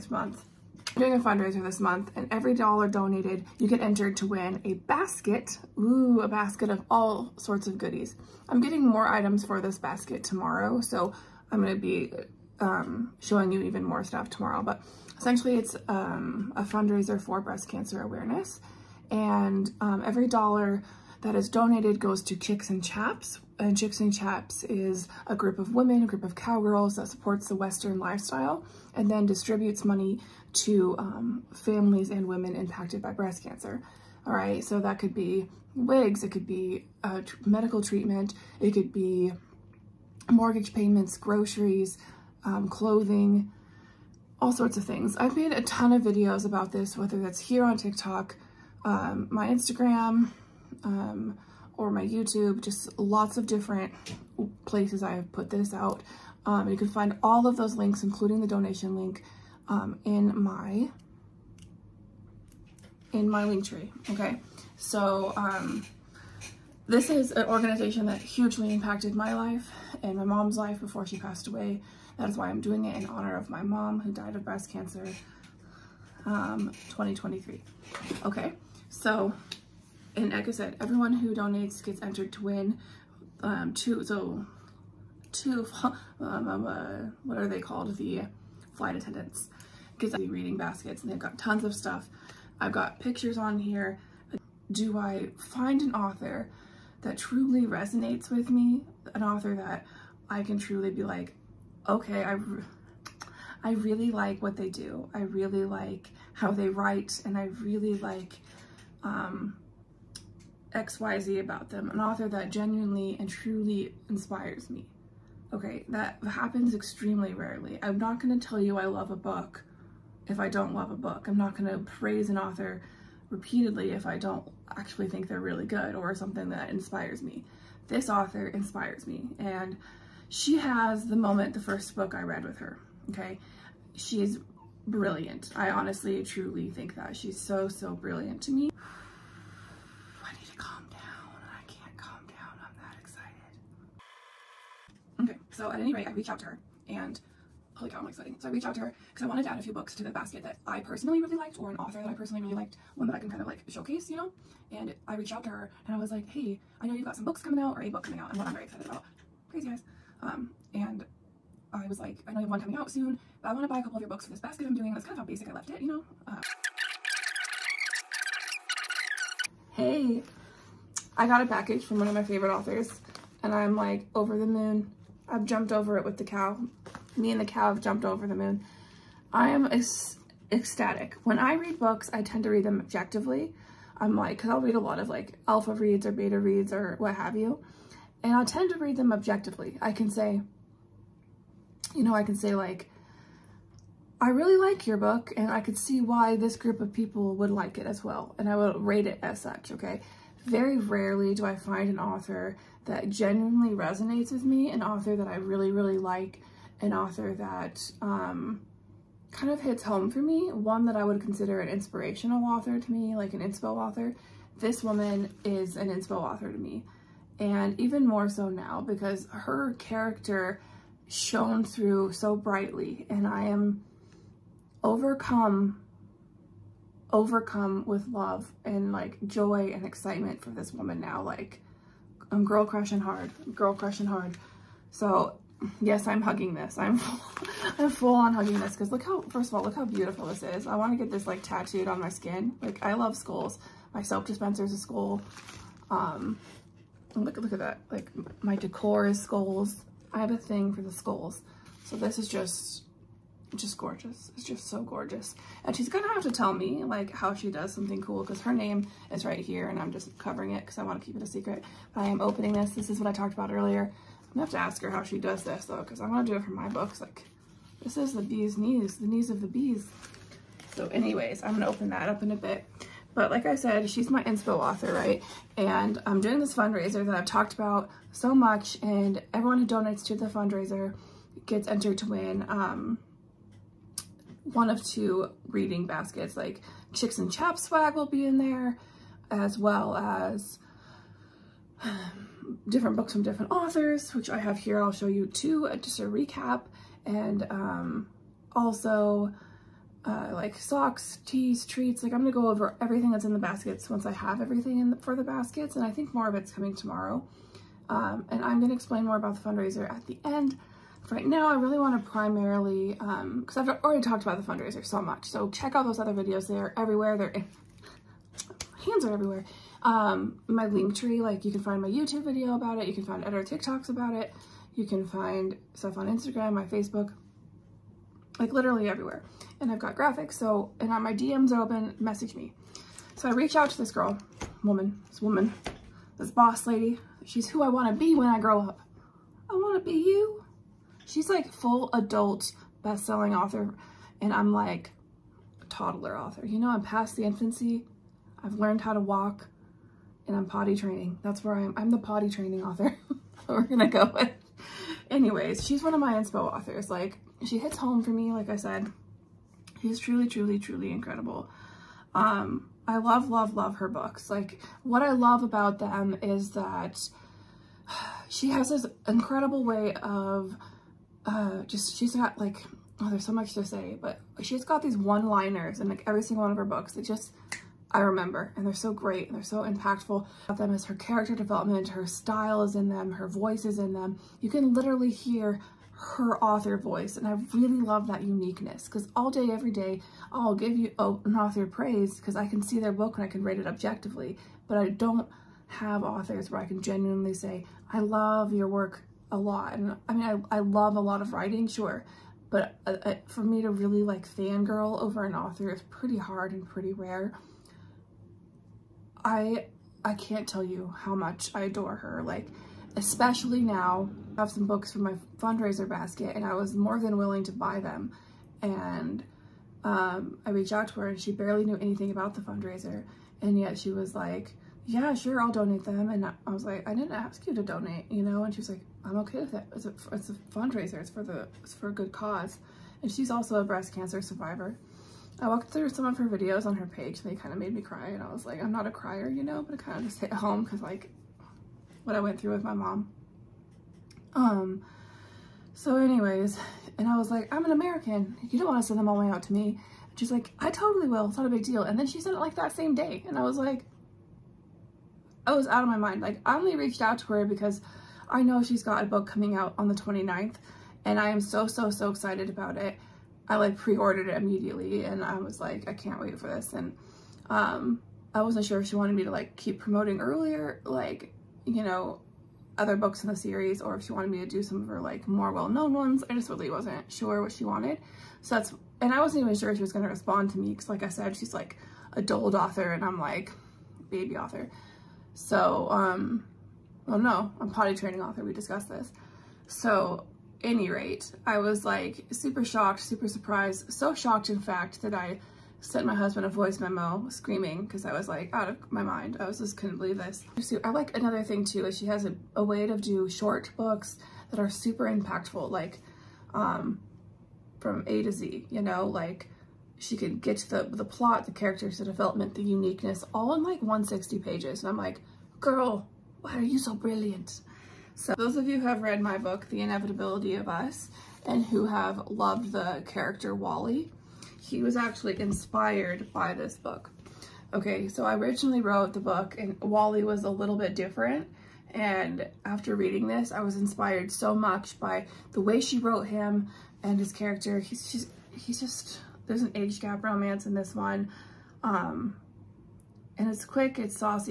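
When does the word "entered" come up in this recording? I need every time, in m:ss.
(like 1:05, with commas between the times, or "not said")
0:03, 1:22, 4:41.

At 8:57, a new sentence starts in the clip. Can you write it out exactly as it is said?
He's just, he's just there's an age gap romance in this one.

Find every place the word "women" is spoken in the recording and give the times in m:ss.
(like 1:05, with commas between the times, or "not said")
0:25, 0:32.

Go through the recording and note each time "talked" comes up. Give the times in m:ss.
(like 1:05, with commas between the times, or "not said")
4:23, 4:37, 5:14.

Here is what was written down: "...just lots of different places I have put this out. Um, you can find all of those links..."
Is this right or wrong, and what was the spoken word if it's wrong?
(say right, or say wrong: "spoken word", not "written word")
right.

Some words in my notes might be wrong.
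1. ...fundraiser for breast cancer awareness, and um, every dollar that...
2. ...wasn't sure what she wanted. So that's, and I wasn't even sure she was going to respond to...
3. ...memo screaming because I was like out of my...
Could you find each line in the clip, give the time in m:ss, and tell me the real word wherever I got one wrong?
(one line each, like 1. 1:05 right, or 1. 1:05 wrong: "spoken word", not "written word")
1. 0:16 right
2. 7:56 right
3. 8:16 right.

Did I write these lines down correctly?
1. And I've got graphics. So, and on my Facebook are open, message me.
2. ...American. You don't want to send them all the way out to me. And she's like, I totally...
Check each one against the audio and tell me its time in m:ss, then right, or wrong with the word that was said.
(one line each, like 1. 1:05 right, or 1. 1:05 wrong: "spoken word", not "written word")
1. 5:29 wrong: "DMs", not "Facebook"
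2. 7:27 right.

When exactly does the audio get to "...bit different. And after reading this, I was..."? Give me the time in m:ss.
8:50.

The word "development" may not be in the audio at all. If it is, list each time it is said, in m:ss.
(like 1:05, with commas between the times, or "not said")
6:21, 8:32.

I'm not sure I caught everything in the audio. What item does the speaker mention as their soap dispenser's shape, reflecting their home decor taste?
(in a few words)
skull.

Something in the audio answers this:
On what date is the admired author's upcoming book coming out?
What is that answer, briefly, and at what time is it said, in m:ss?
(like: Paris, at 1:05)
the 29th, at 7:39.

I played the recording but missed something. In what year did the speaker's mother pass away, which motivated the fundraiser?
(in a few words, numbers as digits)
2023.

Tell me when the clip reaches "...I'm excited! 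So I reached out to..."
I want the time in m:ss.
2:27.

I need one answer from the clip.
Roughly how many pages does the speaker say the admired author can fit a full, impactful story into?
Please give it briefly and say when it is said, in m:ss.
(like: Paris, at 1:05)
160, at 8:33.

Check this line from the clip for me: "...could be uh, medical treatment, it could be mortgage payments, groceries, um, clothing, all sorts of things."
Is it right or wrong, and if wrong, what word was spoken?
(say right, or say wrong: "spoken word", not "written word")
right.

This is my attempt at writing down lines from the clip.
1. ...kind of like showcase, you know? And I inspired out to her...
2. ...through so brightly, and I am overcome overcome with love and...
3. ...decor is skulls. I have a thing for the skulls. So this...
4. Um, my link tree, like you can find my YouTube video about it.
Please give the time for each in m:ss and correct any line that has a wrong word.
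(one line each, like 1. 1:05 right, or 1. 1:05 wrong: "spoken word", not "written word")
1. 2:33 wrong: "reached", not "inspired"
2. 3:41 right
3. 4:08 right
4. 5:19 right.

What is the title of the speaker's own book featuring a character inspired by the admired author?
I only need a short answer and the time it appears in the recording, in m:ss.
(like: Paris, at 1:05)
The Inevitability of Us, at 8:39.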